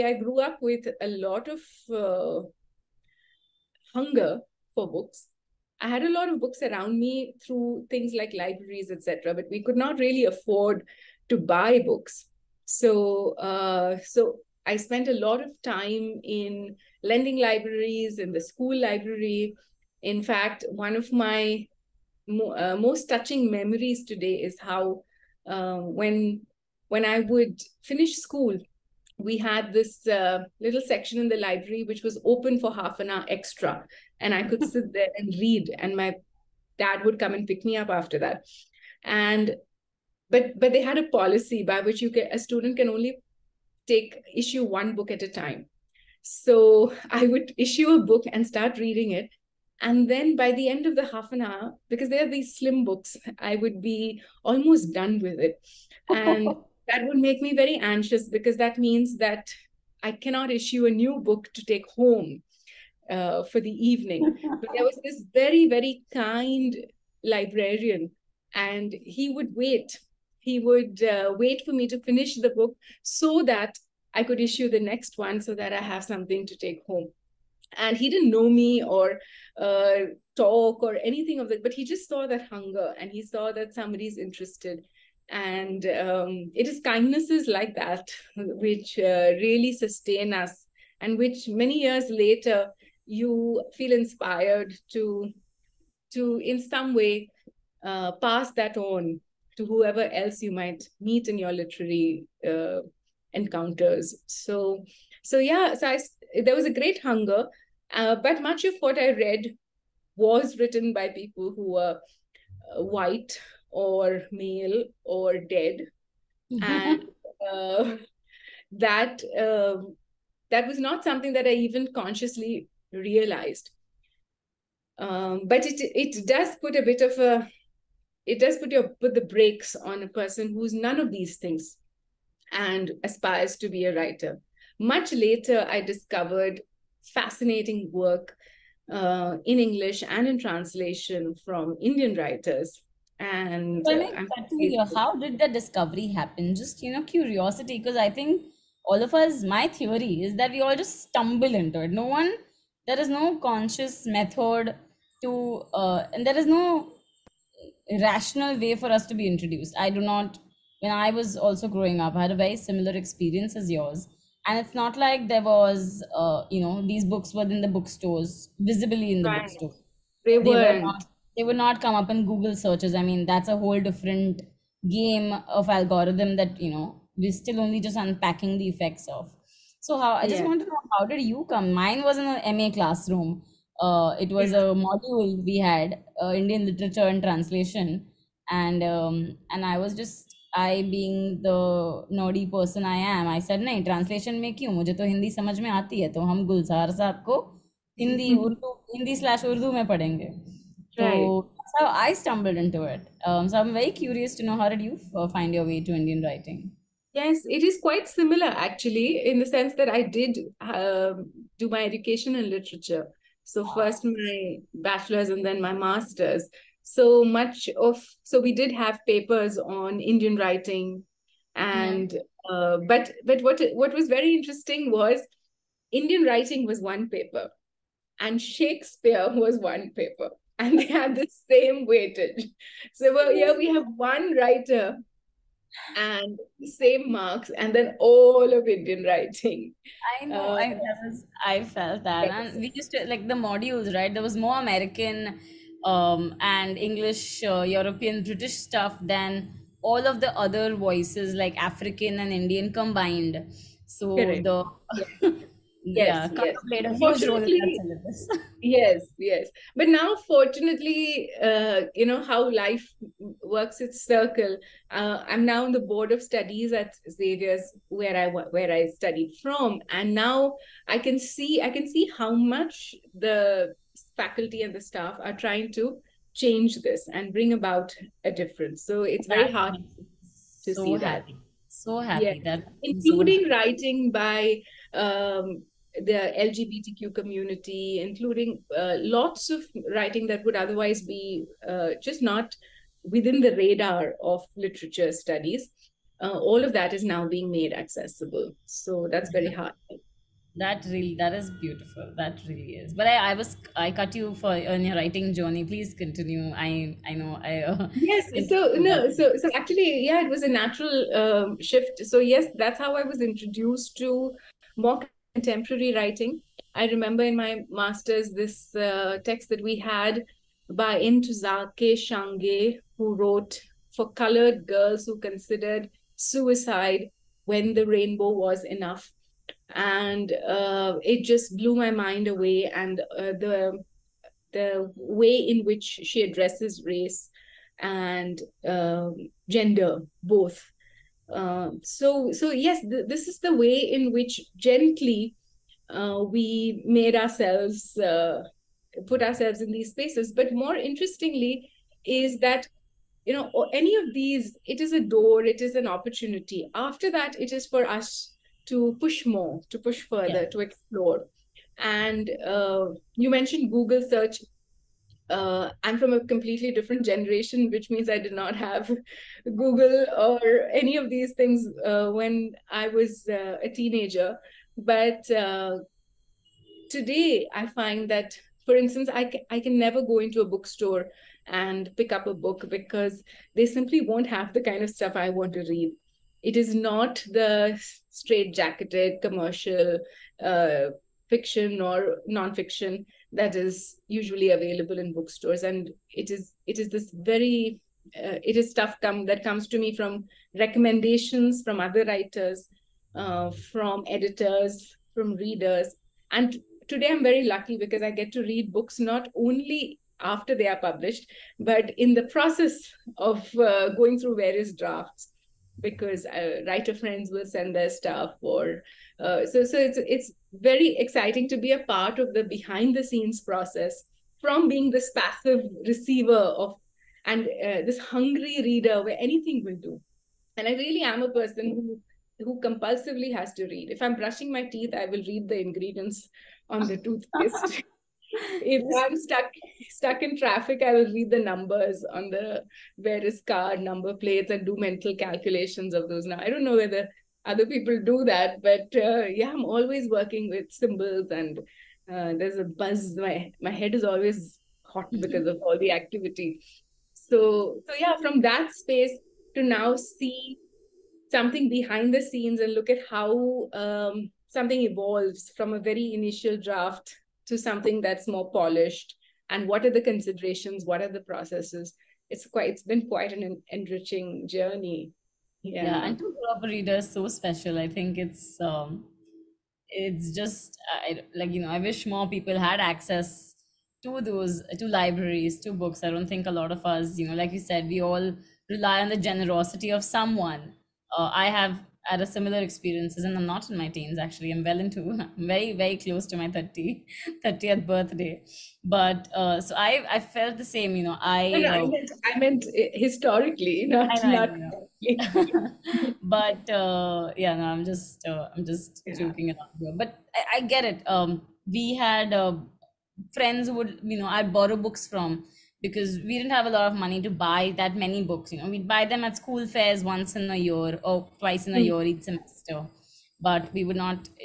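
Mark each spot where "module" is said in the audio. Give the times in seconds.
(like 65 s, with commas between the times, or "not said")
184 s, 243 s.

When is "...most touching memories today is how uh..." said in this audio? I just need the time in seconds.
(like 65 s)
22 s.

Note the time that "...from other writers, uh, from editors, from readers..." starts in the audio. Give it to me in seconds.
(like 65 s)
401 s.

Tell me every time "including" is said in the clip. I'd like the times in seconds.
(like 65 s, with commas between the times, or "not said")
282 s, 288 s.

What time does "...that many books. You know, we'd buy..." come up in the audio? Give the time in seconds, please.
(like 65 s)
517 s.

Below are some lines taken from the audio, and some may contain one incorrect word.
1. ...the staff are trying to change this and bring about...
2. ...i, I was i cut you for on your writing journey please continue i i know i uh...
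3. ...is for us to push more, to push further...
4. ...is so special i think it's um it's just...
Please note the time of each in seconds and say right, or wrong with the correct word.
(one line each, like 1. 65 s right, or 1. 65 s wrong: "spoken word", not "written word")
1. 274 s right
2. 303 s right
3. 357 s right
4. 476 s right.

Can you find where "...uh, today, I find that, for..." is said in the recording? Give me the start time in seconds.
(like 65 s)
375 s.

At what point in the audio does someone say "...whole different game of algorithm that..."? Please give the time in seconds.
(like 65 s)
173 s.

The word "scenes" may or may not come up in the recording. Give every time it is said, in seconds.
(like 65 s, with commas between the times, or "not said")
423 s, 462 s.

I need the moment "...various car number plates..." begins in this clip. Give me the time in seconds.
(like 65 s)
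442 s.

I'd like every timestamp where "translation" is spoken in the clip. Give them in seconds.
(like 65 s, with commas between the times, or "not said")
140 s, 187 s.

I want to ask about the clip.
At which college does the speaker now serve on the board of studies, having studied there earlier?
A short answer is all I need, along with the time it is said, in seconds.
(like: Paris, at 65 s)
Xavier's, at 267 s.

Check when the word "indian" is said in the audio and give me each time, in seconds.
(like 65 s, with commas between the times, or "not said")
141 s, 186 s, 205 s, 219 s, 225 s, 238 s, 252 s.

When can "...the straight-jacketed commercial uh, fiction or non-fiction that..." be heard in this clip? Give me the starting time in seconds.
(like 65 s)
387 s.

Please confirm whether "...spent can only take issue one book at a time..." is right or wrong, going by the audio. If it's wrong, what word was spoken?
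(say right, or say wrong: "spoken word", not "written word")
wrong: "student", not "spent".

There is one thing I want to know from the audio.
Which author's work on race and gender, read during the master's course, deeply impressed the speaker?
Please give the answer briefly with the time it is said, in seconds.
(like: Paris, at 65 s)
Ntozake Shange, at 320 s.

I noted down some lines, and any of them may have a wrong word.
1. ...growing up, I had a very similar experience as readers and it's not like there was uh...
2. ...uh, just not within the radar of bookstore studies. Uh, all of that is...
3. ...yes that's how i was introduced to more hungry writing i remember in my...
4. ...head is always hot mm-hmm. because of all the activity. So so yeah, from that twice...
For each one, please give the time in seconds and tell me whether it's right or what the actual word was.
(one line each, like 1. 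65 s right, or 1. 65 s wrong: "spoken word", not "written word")
1. 161 s wrong: "yours", not "readers"
2. 291 s wrong: "literature", not "bookstore"
3. 312 s wrong: "contemporary", not "hungry"
4. 453 s wrong: "space", not "twice".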